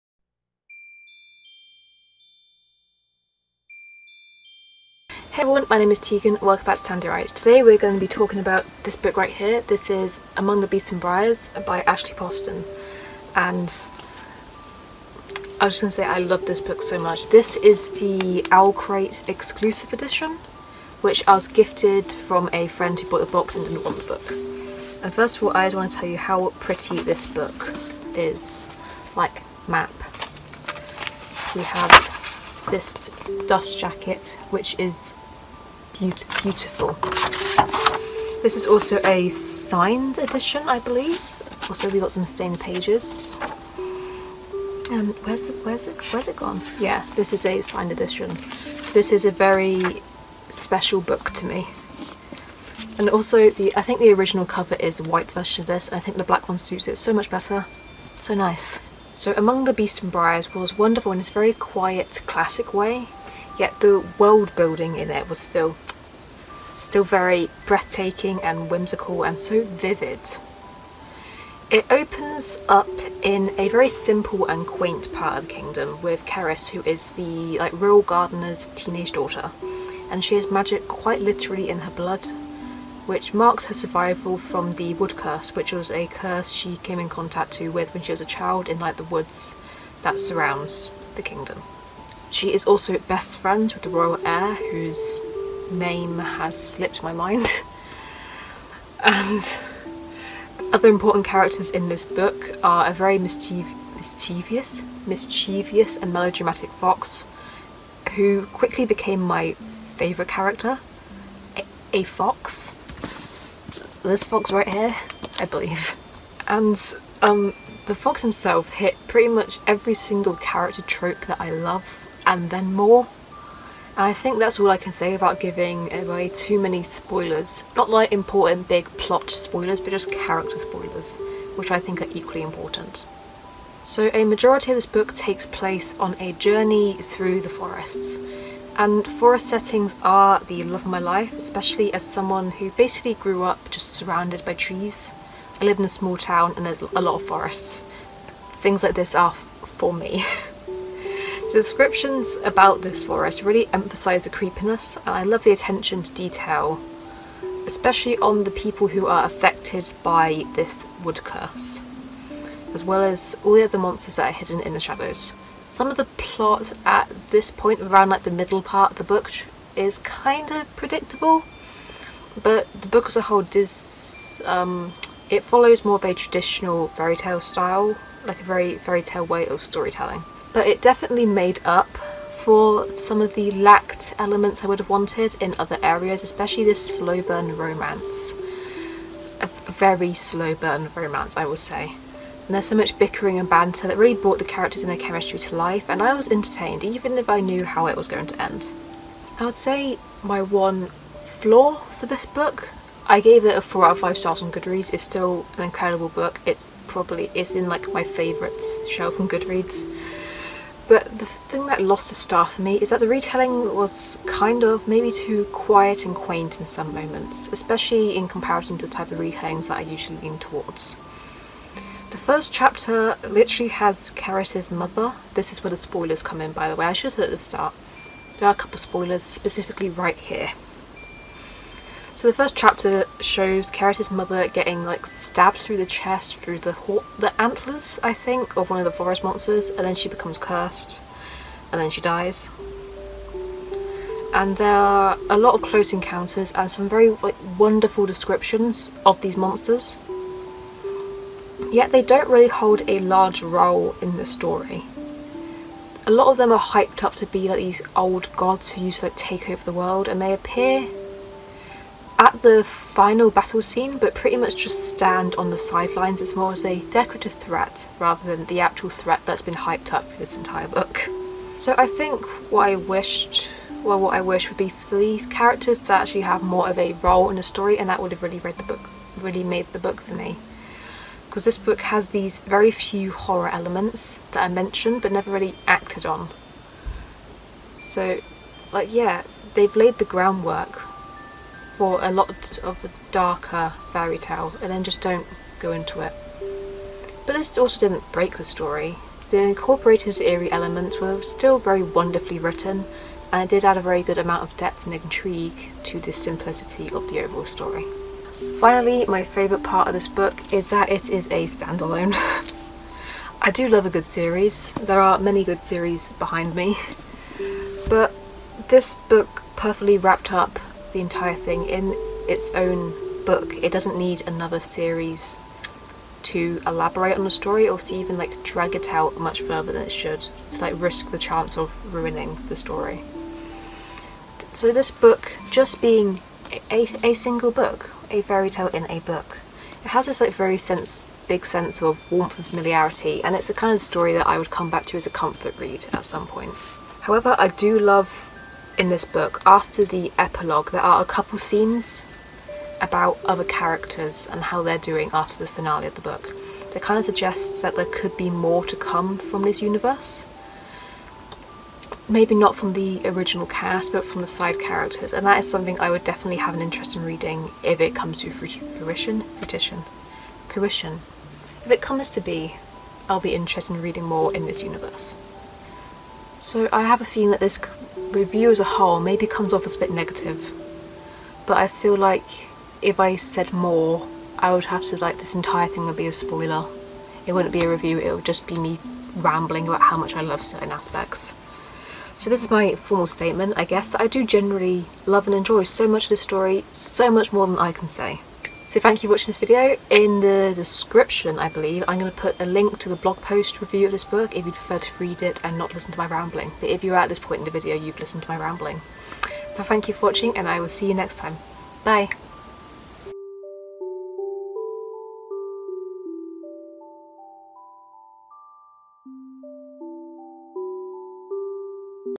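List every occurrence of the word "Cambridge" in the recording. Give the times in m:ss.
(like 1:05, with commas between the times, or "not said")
not said.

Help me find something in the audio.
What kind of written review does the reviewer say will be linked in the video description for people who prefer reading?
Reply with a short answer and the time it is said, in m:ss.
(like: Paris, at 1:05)
Blog post, at 6:42.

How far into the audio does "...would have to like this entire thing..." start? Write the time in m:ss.
6:24.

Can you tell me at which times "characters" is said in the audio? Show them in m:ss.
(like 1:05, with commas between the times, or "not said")
1:41, 1:50, 2:00, 2:10, 3:14, 4:35, 5:53, 6:04.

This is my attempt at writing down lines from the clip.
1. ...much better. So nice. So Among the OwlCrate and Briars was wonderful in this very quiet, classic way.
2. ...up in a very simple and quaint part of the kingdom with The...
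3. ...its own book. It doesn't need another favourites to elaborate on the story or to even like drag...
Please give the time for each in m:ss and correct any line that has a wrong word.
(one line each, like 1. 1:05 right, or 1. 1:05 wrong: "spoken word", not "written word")
1. 0:57 wrong: "Beasts", not "OwlCrate"
2. 1:12 wrong: "Cerys", not "The"
3. 5:22 wrong: "series", not "favourites".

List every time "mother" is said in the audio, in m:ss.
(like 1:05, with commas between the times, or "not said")
3:44, 3:54.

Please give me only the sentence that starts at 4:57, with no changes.
But this also didn't break the story.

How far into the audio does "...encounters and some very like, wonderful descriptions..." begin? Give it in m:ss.
4:05.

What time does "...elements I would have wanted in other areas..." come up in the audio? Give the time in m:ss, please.
3:04.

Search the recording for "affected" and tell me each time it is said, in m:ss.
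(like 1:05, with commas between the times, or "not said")
2:39.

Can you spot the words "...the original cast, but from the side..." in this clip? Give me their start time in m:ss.
6:02.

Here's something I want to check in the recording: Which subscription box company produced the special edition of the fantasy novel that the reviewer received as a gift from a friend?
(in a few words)
OwlCrate.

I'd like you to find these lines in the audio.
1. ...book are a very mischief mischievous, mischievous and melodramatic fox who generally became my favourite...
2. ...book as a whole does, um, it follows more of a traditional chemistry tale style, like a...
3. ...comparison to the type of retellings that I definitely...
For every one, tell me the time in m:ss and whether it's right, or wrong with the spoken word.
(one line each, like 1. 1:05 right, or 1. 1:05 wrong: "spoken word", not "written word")
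1. 1:42 wrong: "quickly", not "generally"
2. 2:52 wrong: "fairy", not "chemistry"
3. 3:38 wrong: "usually", not "definitely".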